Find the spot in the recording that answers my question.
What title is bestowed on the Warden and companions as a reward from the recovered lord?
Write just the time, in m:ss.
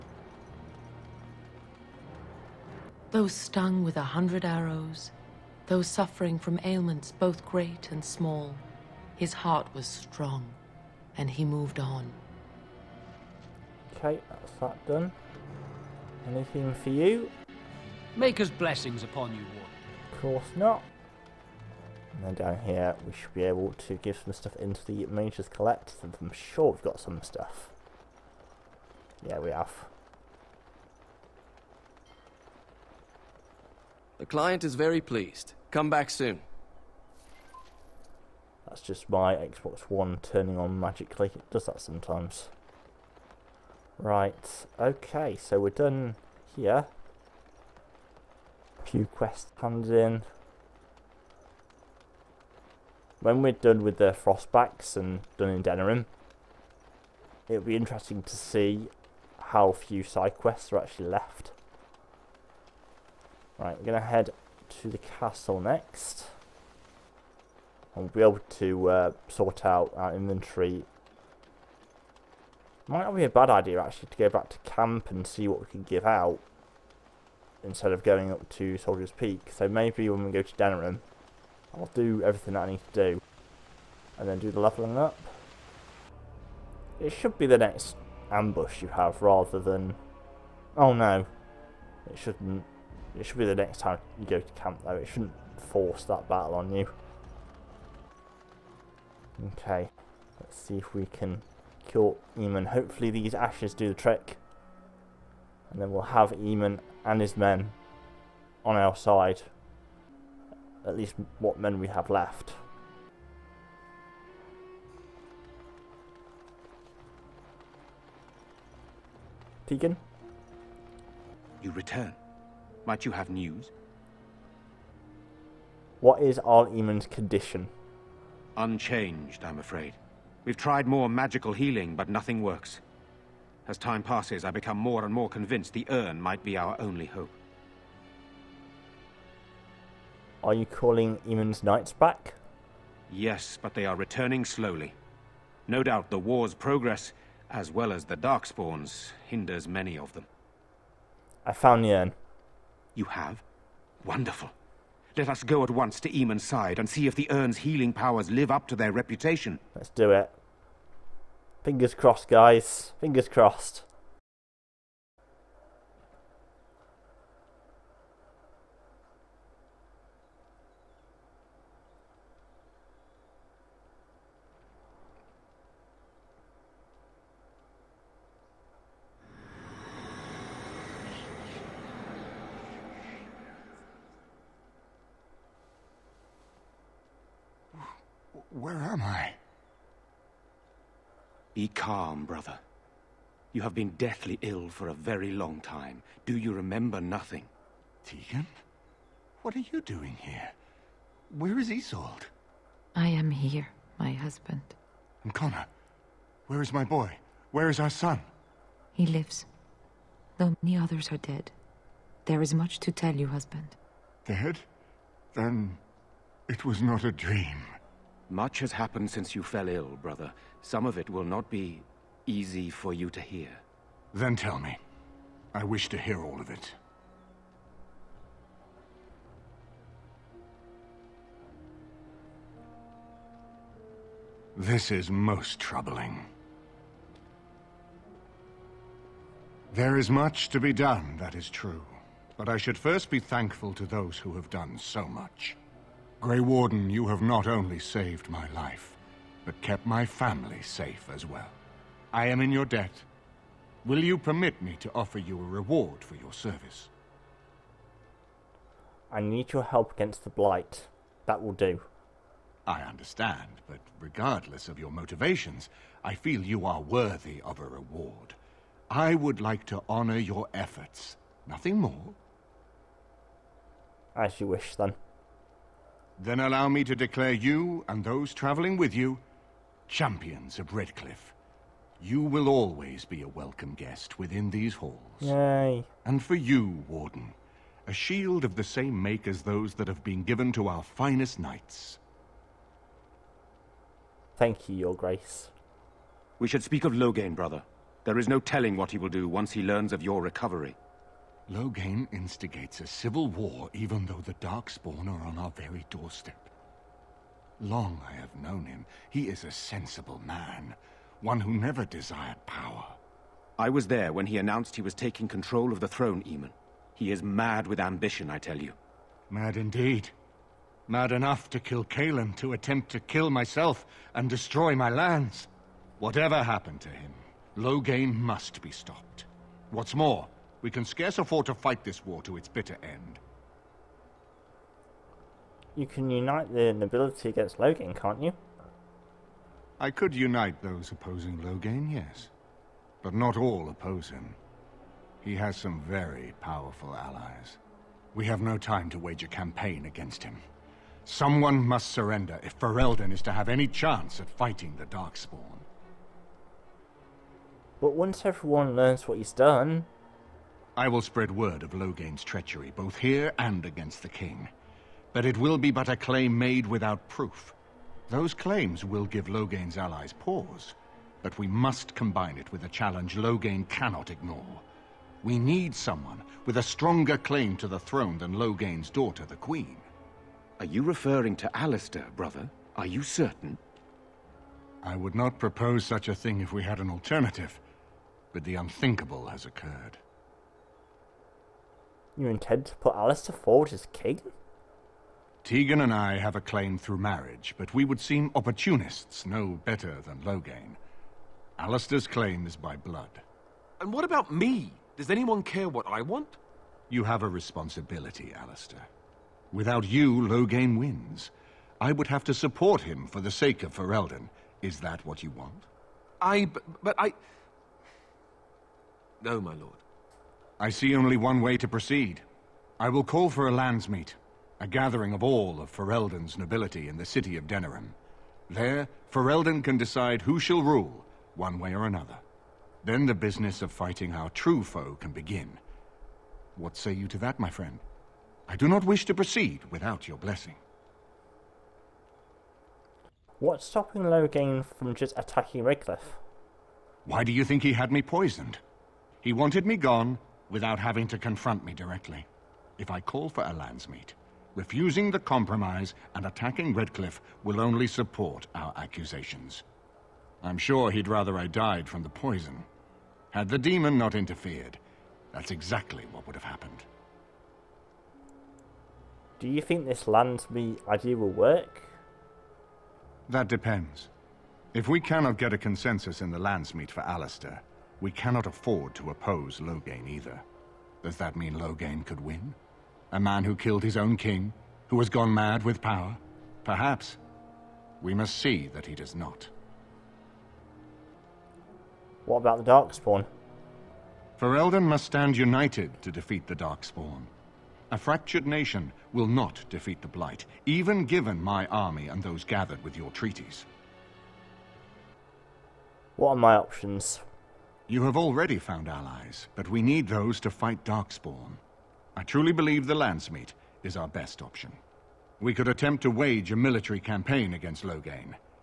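4:39.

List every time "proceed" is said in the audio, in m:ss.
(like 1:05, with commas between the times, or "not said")
7:01, 7:19.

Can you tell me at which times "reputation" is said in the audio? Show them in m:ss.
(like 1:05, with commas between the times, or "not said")
2:38.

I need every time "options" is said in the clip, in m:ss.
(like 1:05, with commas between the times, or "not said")
8:26, 8:34.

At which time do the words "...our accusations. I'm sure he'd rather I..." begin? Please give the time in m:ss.
7:38.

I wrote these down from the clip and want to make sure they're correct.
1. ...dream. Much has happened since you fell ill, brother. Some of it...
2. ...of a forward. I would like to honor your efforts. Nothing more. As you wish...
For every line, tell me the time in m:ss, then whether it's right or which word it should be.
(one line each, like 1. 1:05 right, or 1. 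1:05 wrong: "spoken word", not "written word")
1. 3:37 right
2. 4:27 wrong: "reward", not "forward".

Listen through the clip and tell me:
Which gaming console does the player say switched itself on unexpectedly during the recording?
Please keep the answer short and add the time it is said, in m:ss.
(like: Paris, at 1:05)
Xbox One, at 0:39.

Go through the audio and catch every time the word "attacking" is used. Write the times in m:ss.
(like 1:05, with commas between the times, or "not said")
7:25, 7:36.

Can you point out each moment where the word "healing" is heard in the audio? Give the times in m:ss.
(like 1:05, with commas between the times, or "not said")
2:11, 2:37.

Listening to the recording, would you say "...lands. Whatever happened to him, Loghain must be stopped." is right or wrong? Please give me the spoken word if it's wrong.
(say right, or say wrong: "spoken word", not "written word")
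right.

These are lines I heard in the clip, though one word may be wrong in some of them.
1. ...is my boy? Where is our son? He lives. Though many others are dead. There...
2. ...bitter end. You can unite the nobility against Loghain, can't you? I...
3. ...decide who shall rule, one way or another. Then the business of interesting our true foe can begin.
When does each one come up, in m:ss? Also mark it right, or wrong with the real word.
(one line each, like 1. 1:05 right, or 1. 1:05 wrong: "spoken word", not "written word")
1. 3:26 right
2. 5:32 right
3. 7:09 wrong: "fighting", not "interesting".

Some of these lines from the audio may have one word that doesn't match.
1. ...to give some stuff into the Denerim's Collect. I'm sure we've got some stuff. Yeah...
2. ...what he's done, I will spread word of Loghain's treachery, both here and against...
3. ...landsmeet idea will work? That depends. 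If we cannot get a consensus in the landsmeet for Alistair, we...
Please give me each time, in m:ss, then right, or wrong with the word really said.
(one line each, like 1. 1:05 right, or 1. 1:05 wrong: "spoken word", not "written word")
1. 0:23 wrong: "Mage", not "Denerim"
2. 5:59 right
3. 7:50 right.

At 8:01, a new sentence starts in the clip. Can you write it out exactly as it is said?
Does that mean Loghain could win?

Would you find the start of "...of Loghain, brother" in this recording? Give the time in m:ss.
4:56.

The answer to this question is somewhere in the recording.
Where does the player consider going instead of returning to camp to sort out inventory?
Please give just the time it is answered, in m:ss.
1:18.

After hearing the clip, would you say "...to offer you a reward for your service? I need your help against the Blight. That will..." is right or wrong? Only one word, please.
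right.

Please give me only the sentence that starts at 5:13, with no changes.
I was there when he announced he was taking control of the throne, Eamon.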